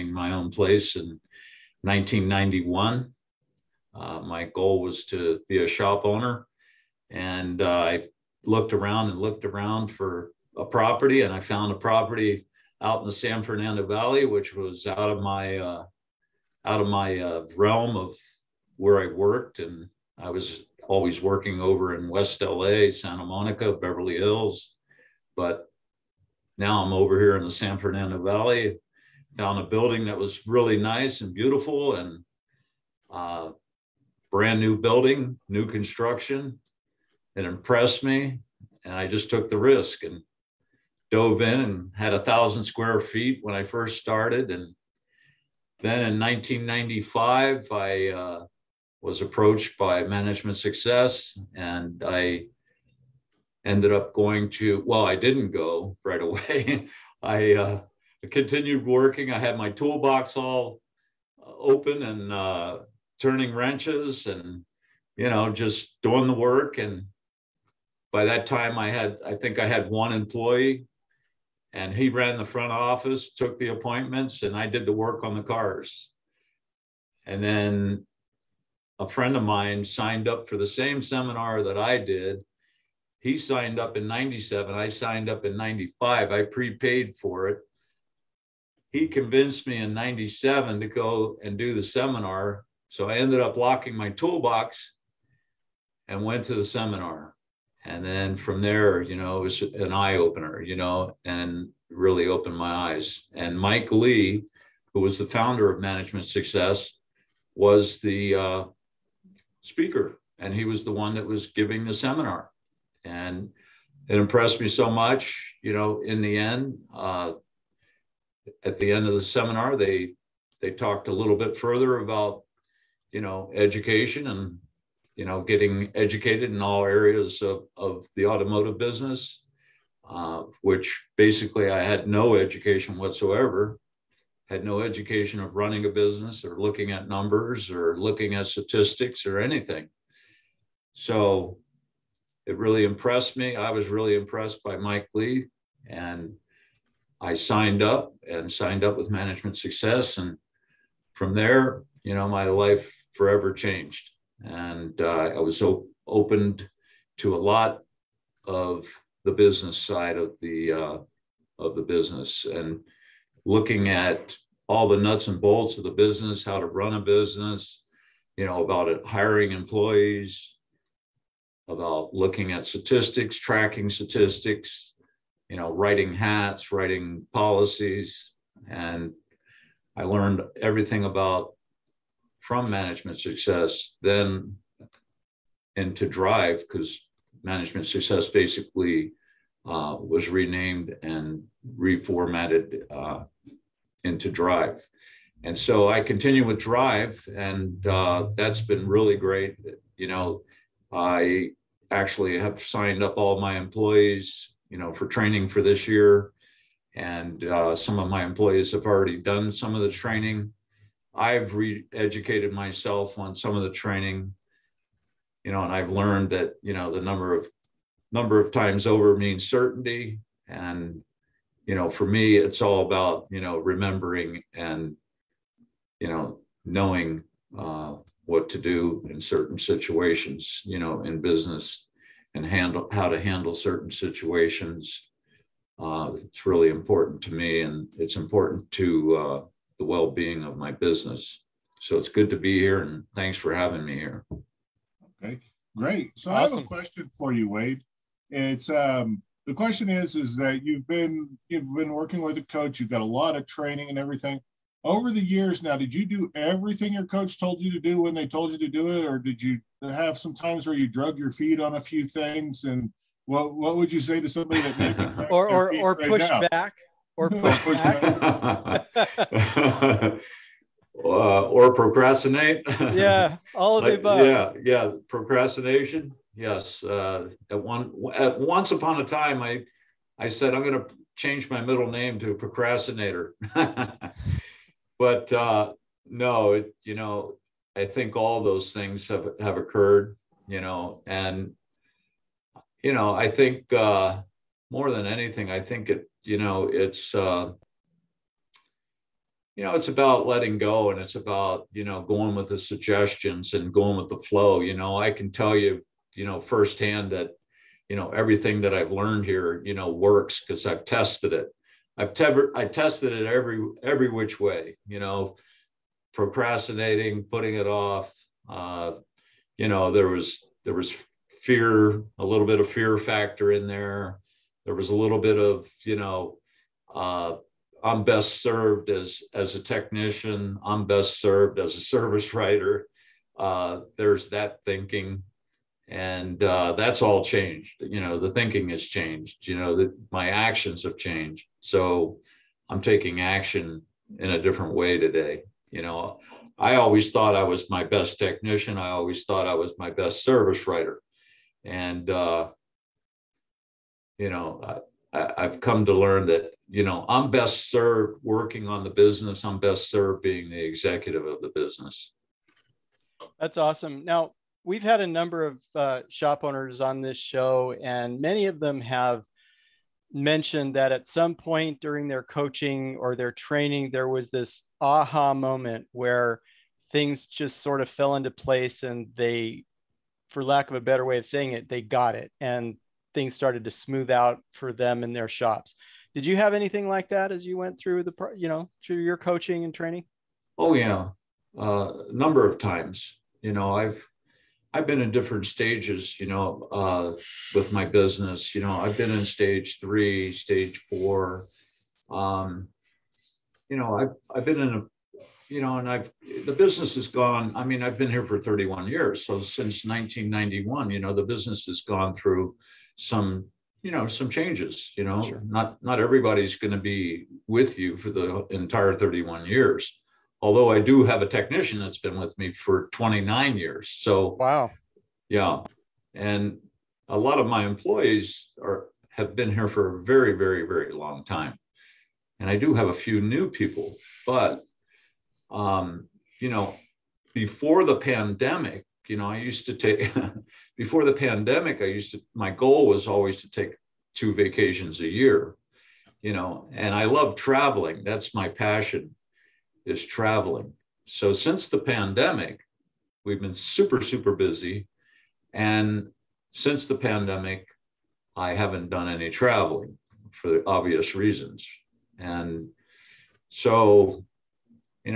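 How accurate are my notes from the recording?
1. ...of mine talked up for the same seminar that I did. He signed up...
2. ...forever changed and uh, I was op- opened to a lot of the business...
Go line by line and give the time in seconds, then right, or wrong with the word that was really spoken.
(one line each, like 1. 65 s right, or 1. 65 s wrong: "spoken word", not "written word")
1. 79 s wrong: "signed", not "talked"
2. 153 s right.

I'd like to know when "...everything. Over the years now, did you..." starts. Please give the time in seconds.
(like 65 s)
253 s.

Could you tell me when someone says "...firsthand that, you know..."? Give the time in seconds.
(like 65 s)
306 s.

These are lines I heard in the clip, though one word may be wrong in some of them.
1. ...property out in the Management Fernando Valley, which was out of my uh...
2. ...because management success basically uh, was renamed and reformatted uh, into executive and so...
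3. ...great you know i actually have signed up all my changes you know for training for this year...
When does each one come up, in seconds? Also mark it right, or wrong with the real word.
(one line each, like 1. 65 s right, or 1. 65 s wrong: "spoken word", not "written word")
1. 11 s wrong: "San", not "Management"
2. 186 s wrong: "drive", not "executive"
3. 199 s wrong: "employees", not "changes".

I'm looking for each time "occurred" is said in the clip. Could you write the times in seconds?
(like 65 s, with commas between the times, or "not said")
289 s.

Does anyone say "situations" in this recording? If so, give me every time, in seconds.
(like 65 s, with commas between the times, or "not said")
229 s, 233 s.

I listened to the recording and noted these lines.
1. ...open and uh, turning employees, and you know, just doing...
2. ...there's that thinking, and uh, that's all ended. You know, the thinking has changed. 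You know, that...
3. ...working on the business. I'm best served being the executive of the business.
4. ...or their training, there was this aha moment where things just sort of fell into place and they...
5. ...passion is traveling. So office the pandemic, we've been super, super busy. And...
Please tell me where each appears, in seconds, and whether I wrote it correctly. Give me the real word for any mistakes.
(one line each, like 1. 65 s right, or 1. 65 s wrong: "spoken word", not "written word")
1. 61 s wrong: "wrenches", not "employees"
2. 333 s wrong: "changed", not "ended"
3. 358 s right
4. 373 s right
5. 448 s wrong: "since", not "office".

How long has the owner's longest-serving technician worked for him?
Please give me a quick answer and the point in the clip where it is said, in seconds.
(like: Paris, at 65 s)
29 years, at 422 s.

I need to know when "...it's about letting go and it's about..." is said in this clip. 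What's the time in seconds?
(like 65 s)
299 s.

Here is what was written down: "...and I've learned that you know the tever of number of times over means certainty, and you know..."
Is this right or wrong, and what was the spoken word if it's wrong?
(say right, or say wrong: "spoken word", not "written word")
wrong: "number", not "tever".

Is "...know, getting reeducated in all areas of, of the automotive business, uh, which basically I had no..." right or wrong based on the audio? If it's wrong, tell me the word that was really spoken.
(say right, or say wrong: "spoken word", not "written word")
wrong: "educated", not "reeducated".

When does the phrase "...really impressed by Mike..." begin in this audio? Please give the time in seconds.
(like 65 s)
143 s.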